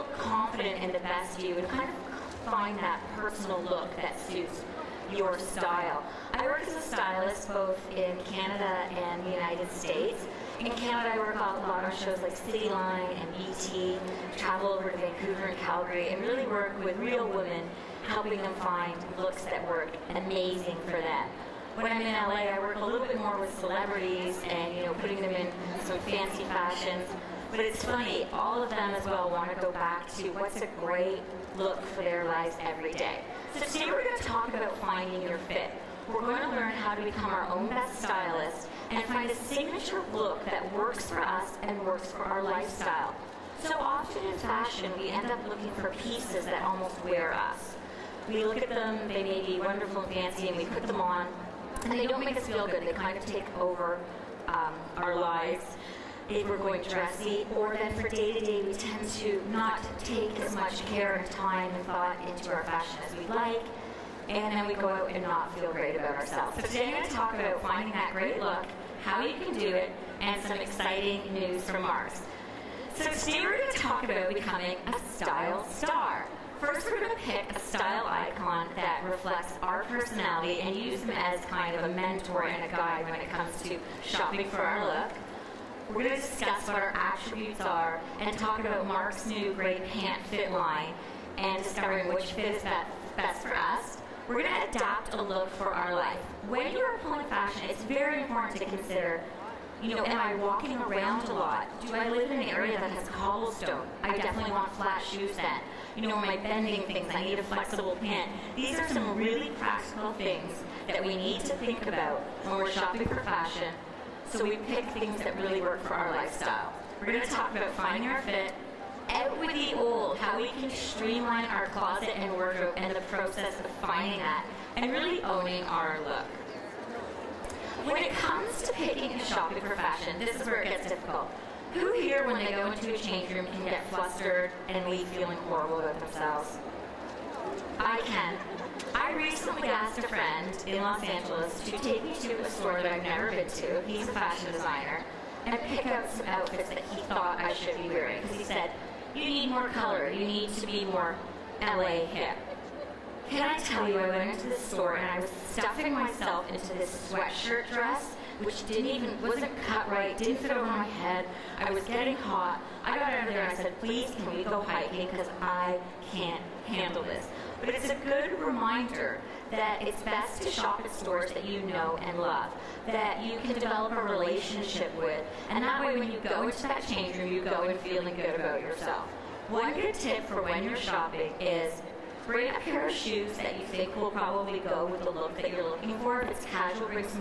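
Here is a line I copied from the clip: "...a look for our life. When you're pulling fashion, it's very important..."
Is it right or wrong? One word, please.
right.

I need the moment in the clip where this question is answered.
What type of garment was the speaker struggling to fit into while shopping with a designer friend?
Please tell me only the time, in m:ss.
2:37.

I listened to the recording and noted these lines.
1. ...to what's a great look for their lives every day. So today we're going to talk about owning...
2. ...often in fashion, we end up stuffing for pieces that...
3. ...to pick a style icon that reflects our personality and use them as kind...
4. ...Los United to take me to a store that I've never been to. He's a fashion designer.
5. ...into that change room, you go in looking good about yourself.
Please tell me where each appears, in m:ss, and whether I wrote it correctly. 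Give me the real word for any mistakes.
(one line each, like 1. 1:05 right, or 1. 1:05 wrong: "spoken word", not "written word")
1. 0:30 wrong: "finding", not "owning"
2. 0:43 wrong: "looking", not "stuffing"
3. 1:17 right
4. 2:20 wrong: "Angeles", not "United"
5. 2:56 wrong: "feeling", not "looking".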